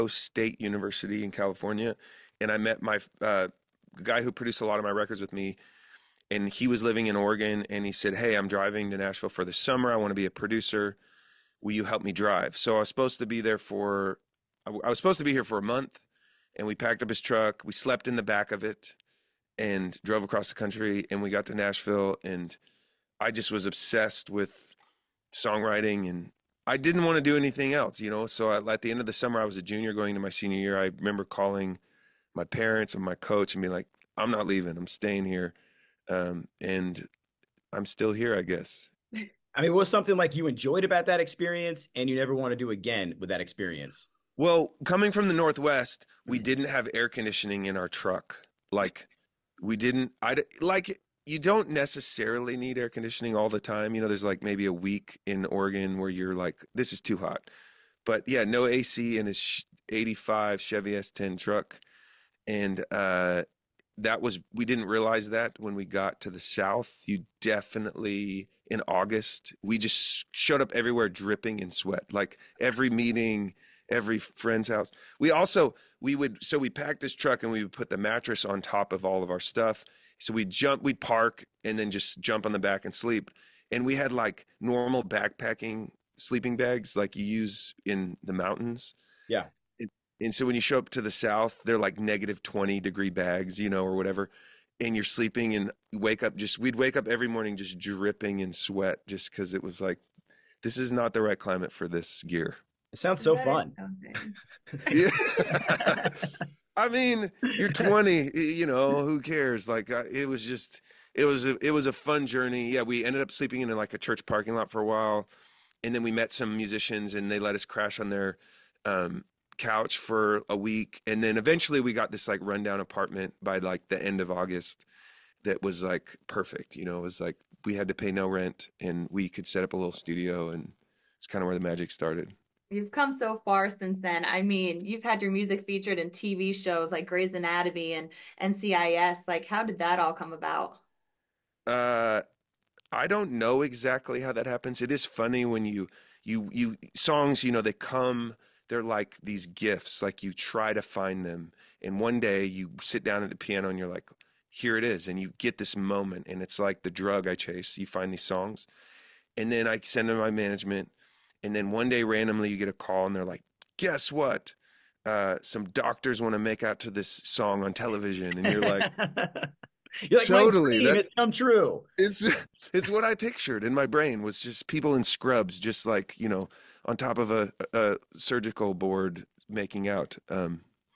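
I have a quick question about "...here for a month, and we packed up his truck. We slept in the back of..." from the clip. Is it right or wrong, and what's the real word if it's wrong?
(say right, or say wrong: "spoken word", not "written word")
right.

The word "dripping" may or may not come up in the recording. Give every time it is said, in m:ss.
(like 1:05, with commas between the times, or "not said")
1:11, 1:37.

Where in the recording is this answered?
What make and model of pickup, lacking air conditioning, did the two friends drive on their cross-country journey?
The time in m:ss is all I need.
1:00.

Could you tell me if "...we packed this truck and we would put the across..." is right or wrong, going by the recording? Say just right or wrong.
wrong.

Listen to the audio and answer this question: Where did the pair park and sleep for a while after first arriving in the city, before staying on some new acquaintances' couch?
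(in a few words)
church parking lot.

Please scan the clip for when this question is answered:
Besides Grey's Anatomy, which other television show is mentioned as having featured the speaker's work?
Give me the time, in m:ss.
2:18.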